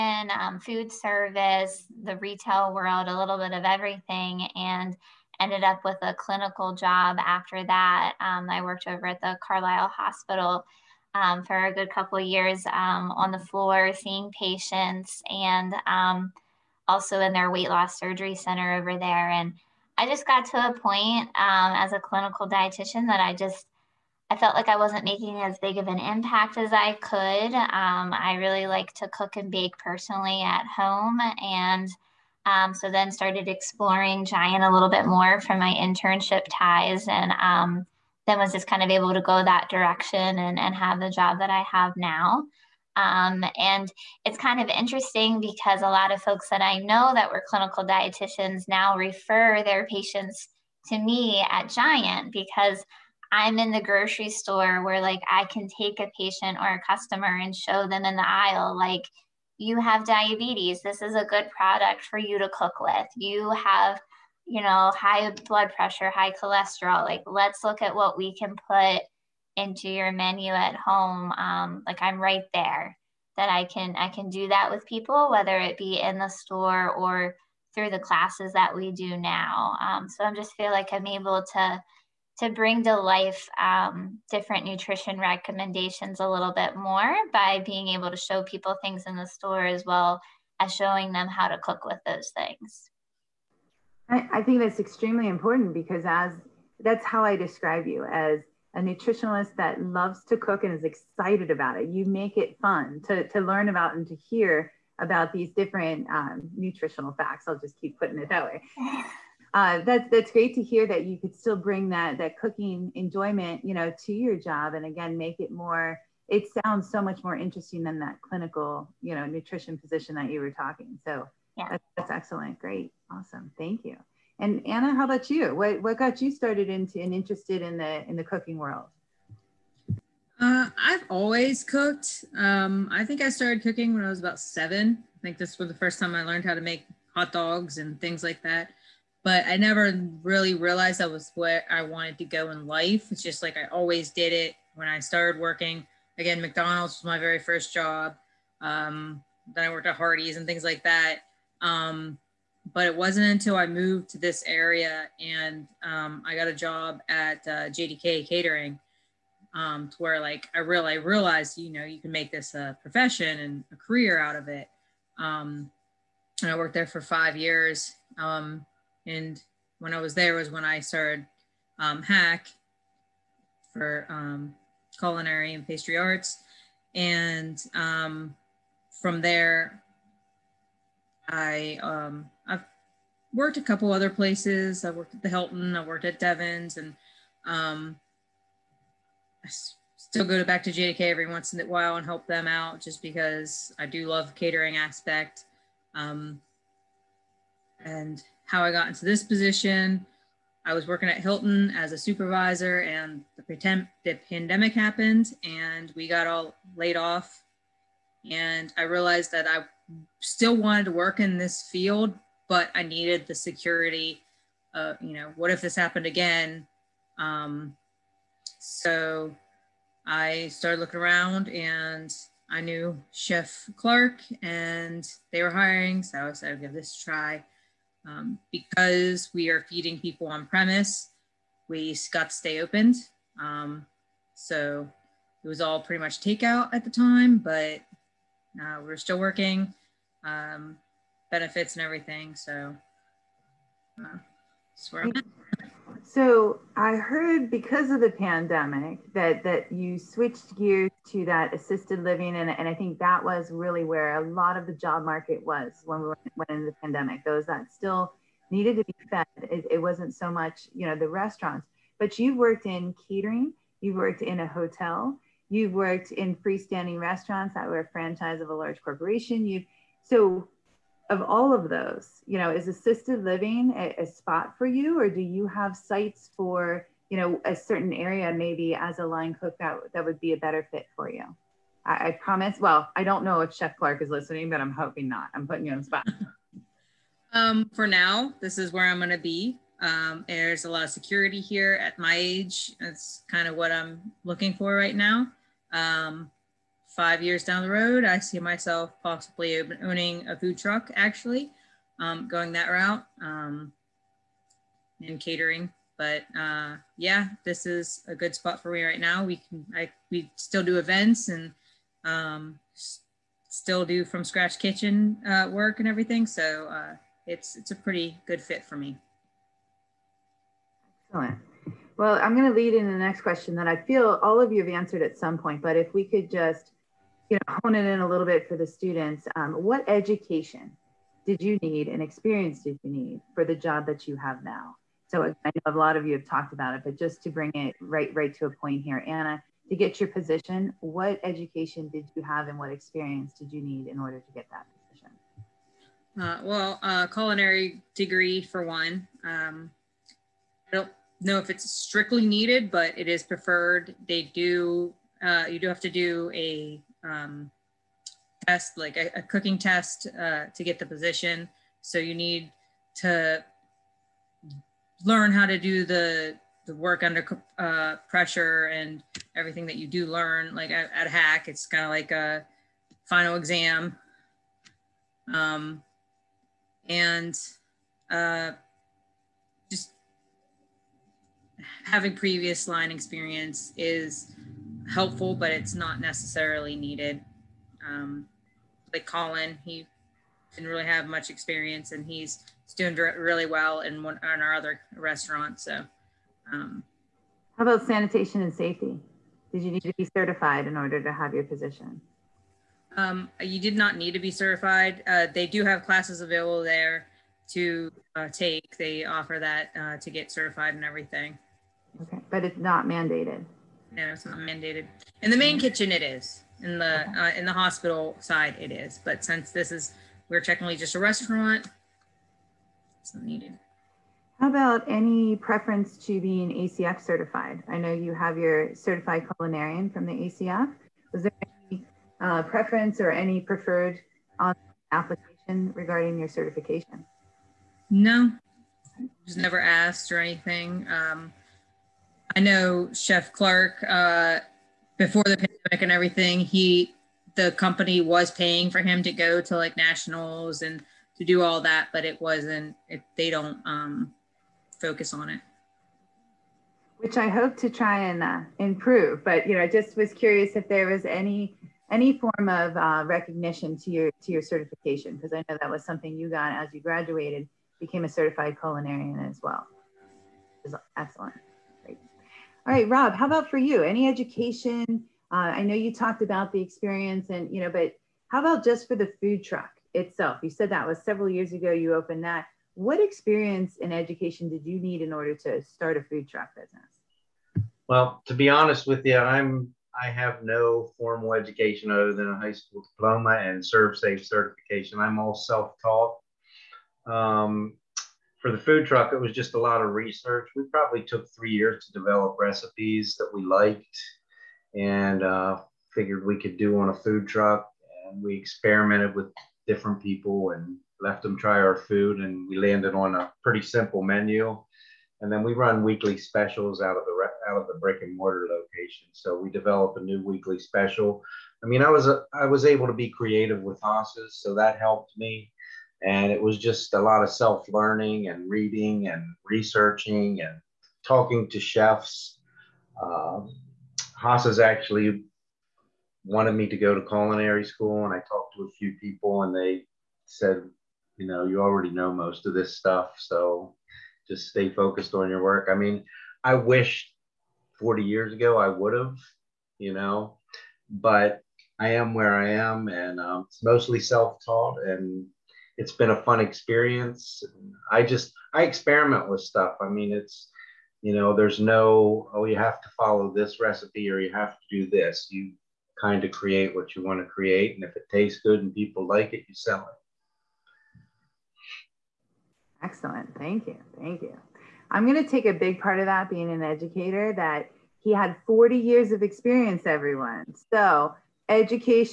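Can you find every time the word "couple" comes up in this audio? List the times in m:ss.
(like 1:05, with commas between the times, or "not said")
0:11, 3:03.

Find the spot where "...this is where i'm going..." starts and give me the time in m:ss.
4:48.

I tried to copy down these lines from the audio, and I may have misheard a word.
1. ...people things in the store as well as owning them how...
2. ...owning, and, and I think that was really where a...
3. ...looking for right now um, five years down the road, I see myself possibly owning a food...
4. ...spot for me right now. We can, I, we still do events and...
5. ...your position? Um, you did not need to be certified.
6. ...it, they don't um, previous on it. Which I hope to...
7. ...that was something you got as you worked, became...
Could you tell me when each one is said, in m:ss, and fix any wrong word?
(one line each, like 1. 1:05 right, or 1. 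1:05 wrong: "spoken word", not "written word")
1. 1:28 wrong: "showing", not "owning"
2. 4:12 wrong: "living", not "owning"
3. 4:54 right
4. 5:08 right
5. 6:41 right
6. 7:32 wrong: "focus", not "previous"
7. 7:45 wrong: "graduated", not "worked".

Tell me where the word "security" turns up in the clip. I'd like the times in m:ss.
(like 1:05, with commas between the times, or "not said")
3:33, 4:50.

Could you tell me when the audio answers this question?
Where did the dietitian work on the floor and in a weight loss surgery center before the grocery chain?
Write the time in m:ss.
0:09.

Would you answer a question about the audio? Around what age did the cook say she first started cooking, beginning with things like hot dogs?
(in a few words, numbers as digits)
7.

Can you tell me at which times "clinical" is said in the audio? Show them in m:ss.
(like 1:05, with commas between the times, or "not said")
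0:06, 0:22, 0:47, 1:58.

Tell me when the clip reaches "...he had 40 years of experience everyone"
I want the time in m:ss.
9:38.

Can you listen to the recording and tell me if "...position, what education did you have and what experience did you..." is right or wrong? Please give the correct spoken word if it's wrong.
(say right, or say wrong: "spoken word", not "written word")
right.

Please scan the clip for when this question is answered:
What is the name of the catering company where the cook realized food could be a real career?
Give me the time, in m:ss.
2:37.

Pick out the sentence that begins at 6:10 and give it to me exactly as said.
Like at, at HACC, it's kind of like a final exam.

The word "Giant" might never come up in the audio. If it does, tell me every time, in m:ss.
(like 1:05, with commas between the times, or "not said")
0:34, 0:51.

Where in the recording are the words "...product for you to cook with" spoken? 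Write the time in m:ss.
1:01.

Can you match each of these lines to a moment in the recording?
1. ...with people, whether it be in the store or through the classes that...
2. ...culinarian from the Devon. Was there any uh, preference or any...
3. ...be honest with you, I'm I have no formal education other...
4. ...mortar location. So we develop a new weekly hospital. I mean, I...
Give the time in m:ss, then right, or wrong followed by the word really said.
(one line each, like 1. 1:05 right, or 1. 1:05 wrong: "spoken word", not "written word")
1. 1:14 right
2. 7:09 wrong: "ACF", not "Devon"
3. 8:08 right
4. 8:38 wrong: "special", not "hospital".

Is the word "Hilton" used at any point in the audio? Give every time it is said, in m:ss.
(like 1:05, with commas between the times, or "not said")
3:05, 3:21.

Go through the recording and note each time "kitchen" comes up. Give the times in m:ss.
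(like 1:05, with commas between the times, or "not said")
5:14, 6:55.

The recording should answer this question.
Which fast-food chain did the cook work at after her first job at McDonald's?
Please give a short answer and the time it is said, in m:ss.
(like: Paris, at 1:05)
Hardee's, at 2:29.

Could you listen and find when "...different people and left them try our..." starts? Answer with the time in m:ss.
8:29.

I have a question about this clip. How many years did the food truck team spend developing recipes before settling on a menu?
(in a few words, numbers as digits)
3.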